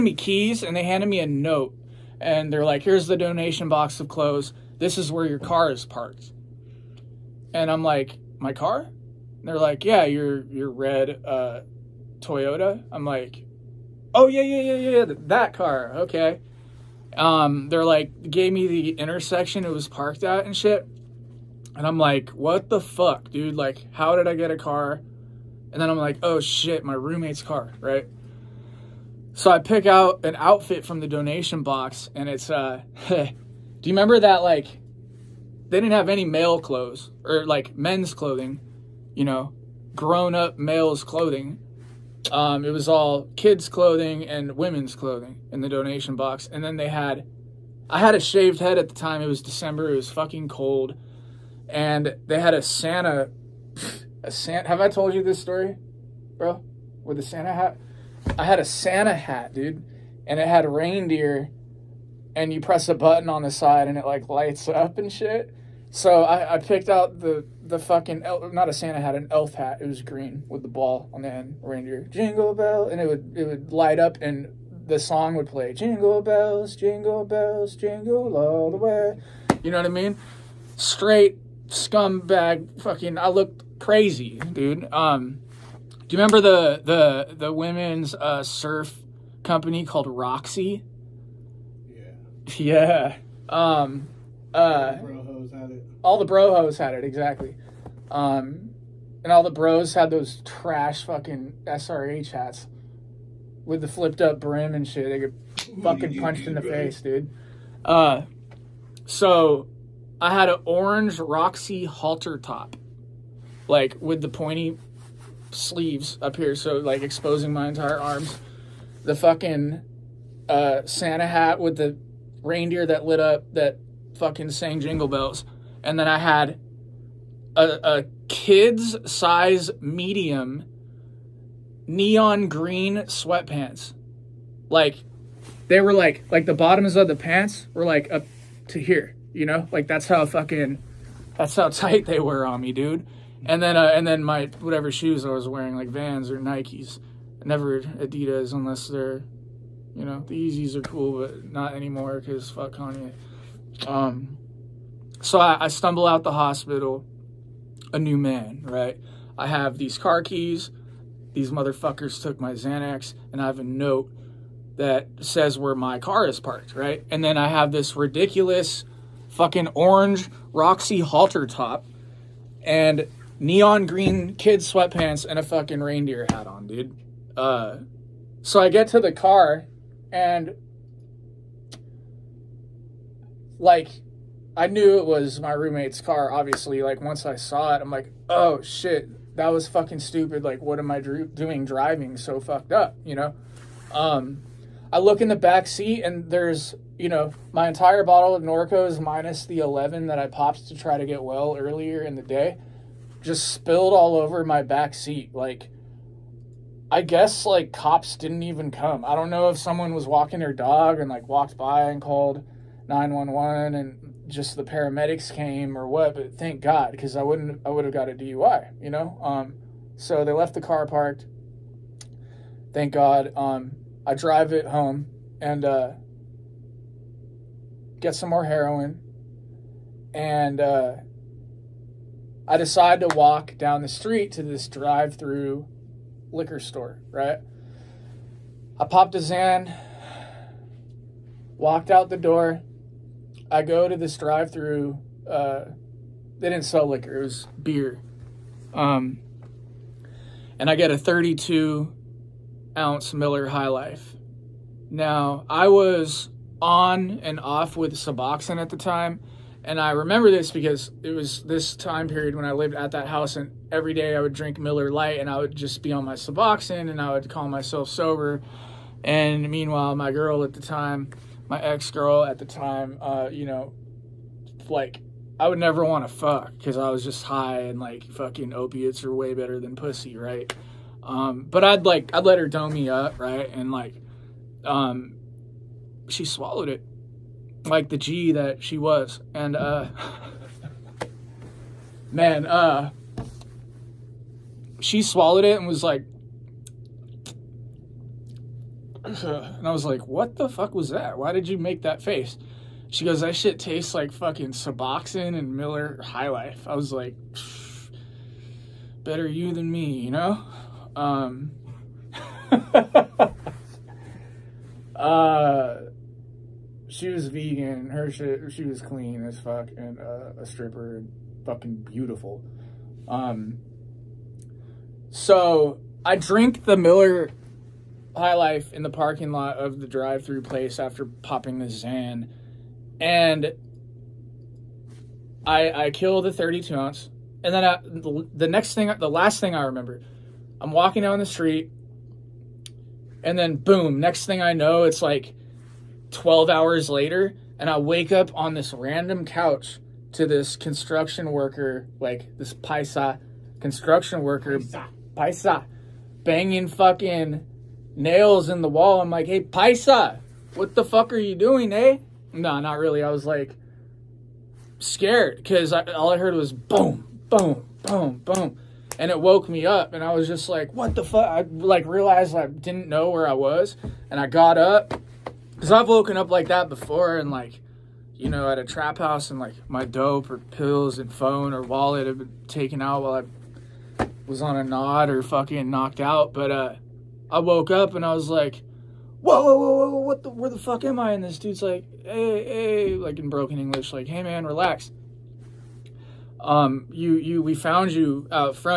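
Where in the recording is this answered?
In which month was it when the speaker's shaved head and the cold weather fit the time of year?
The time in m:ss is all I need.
0:49.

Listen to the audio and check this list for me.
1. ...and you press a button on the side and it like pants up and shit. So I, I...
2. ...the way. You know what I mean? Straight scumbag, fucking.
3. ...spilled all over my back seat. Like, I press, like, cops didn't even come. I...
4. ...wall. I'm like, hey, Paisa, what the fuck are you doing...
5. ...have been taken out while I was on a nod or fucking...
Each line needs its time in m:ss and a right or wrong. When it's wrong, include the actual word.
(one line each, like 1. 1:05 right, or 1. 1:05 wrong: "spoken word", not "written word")
1. 1:02 wrong: "lights", not "pants"
2. 1:18 right
3. 3:23 wrong: "guess", not "press"
4. 5:58 right
5. 6:22 right.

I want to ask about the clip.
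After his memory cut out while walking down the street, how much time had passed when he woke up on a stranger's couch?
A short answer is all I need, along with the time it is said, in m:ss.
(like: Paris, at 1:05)
12 hours, at 5:46.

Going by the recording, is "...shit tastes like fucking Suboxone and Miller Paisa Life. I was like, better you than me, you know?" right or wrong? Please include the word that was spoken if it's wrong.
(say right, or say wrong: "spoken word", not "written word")
wrong: "High", not "Paisa".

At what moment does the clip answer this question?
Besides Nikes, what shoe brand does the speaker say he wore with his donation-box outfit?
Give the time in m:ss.
2:25.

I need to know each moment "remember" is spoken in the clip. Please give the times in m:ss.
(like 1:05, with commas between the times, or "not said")
0:33, 1:26, 4:19, 5:39.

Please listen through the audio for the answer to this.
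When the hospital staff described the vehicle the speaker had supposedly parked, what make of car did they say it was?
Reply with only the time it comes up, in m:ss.
0:12.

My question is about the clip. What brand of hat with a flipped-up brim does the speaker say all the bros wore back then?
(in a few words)
SRH.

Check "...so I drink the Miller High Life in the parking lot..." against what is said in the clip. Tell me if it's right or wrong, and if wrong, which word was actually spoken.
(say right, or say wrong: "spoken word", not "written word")
right.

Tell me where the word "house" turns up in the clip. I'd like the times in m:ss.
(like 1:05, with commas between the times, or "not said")
4:23, 6:18.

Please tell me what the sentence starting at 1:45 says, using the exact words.
They get fucking punched in the face, dude.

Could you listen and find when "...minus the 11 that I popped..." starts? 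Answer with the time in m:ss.
3:18.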